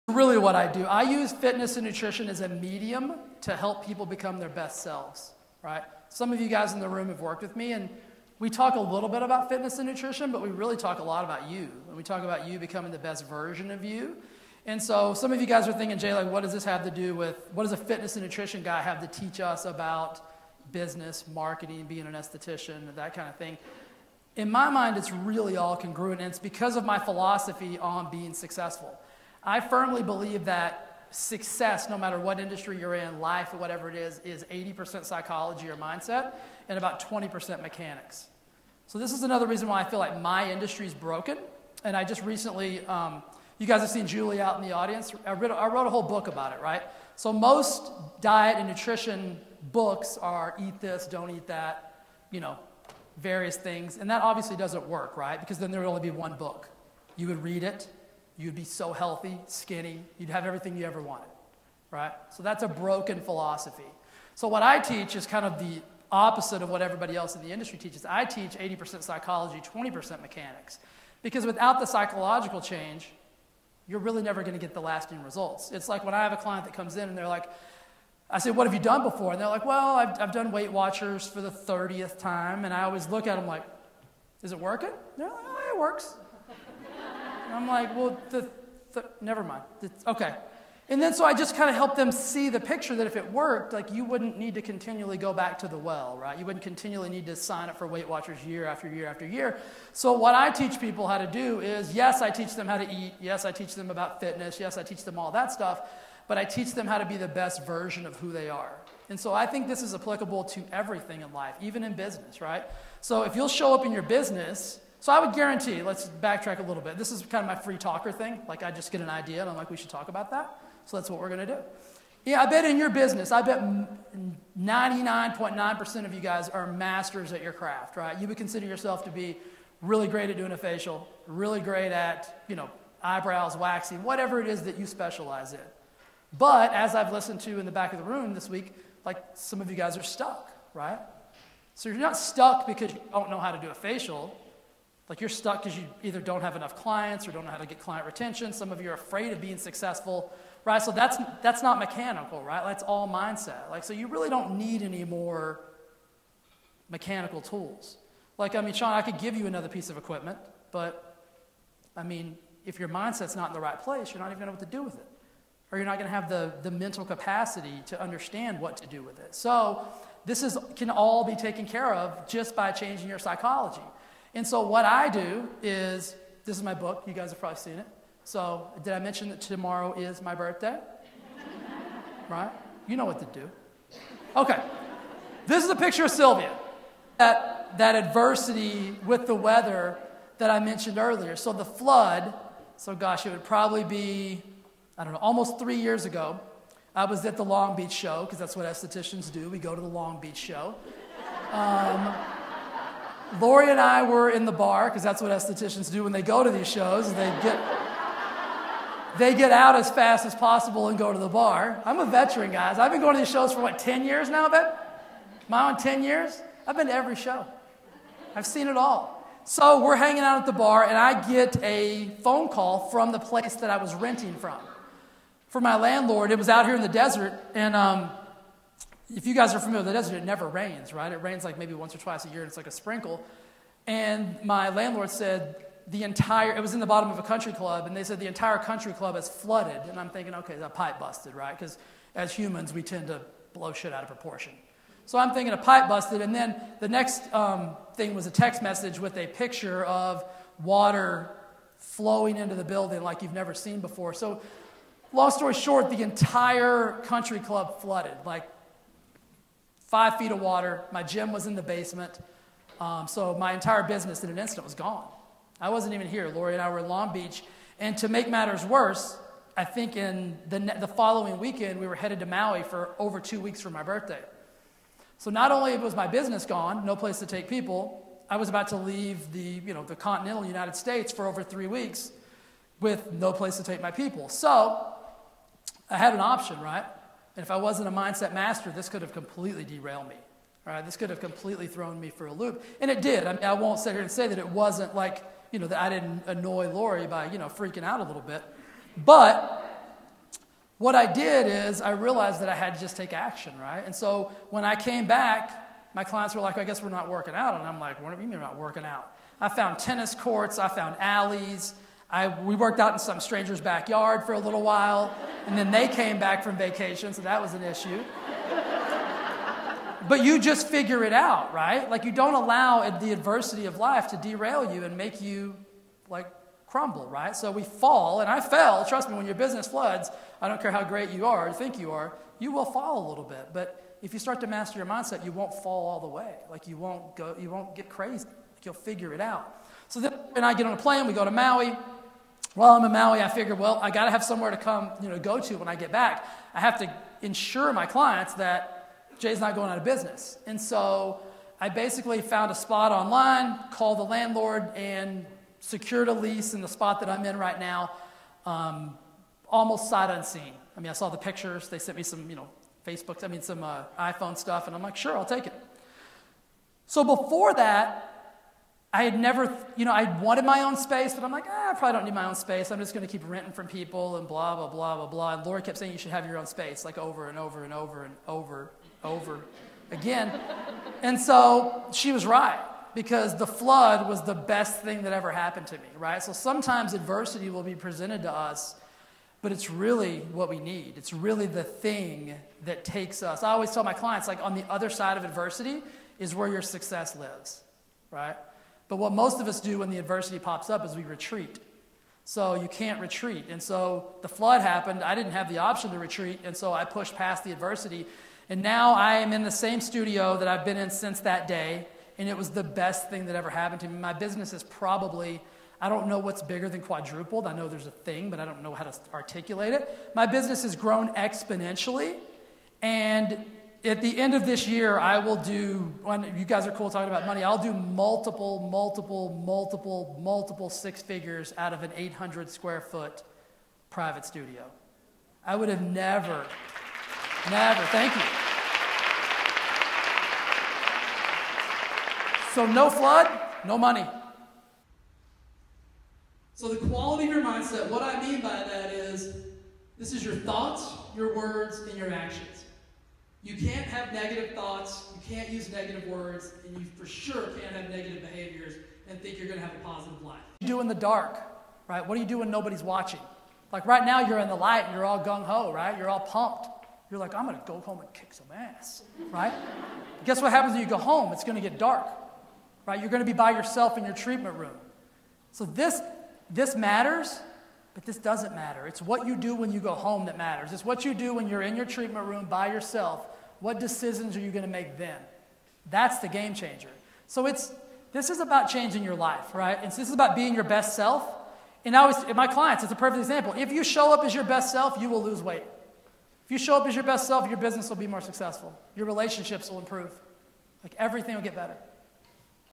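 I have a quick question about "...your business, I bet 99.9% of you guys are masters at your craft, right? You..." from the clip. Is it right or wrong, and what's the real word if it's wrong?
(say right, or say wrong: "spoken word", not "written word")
right.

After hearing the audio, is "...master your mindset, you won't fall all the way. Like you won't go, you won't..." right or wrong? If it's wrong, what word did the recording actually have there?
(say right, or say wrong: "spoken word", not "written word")
right.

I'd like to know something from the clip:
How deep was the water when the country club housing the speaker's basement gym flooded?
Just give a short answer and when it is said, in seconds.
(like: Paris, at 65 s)
5 feet, at 259 s.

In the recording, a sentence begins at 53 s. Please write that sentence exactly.
And that obviously doesn't work, right?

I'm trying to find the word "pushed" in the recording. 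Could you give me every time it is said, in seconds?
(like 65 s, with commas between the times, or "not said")
406 s.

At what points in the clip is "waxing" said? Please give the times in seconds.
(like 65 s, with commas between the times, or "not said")
133 s.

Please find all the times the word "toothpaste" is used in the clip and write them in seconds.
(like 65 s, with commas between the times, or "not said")
not said.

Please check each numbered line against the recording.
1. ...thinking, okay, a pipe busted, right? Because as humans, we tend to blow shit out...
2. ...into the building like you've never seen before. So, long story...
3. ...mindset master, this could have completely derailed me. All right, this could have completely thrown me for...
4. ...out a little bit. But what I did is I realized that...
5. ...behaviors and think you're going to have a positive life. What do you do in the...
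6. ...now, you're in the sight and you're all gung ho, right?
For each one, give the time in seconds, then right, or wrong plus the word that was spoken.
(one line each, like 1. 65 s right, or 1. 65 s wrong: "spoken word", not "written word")
1. 240 s right
2. 252 s right
3. 287 s right
4. 297 s right
5. 458 s right
6. 464 s wrong: "light", not "sight".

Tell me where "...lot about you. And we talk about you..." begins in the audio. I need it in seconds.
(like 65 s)
11 s.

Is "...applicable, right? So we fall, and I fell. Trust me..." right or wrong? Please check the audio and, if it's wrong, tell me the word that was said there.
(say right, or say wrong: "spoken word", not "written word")
wrong: "crumble", not "applicable".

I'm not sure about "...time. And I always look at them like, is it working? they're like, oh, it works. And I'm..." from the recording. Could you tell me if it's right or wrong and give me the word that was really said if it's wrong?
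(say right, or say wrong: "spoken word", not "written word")
right.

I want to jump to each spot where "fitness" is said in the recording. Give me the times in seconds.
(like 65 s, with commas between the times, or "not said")
1 s, 9 s, 17 s, 104 s.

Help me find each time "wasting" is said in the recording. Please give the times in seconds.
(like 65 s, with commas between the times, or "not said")
not said.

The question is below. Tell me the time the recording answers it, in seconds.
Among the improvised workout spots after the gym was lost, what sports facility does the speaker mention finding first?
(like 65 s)
309 s.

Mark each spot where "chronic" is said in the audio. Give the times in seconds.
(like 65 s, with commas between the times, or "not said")
not said.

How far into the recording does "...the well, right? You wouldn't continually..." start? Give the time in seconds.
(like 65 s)
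95 s.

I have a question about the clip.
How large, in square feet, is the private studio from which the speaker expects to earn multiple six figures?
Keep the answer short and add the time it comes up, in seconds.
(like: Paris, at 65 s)
800 square feet, at 431 s.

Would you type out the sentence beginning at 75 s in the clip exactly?
It's like when I have a client that comes in and they're like, I say, what have you done before?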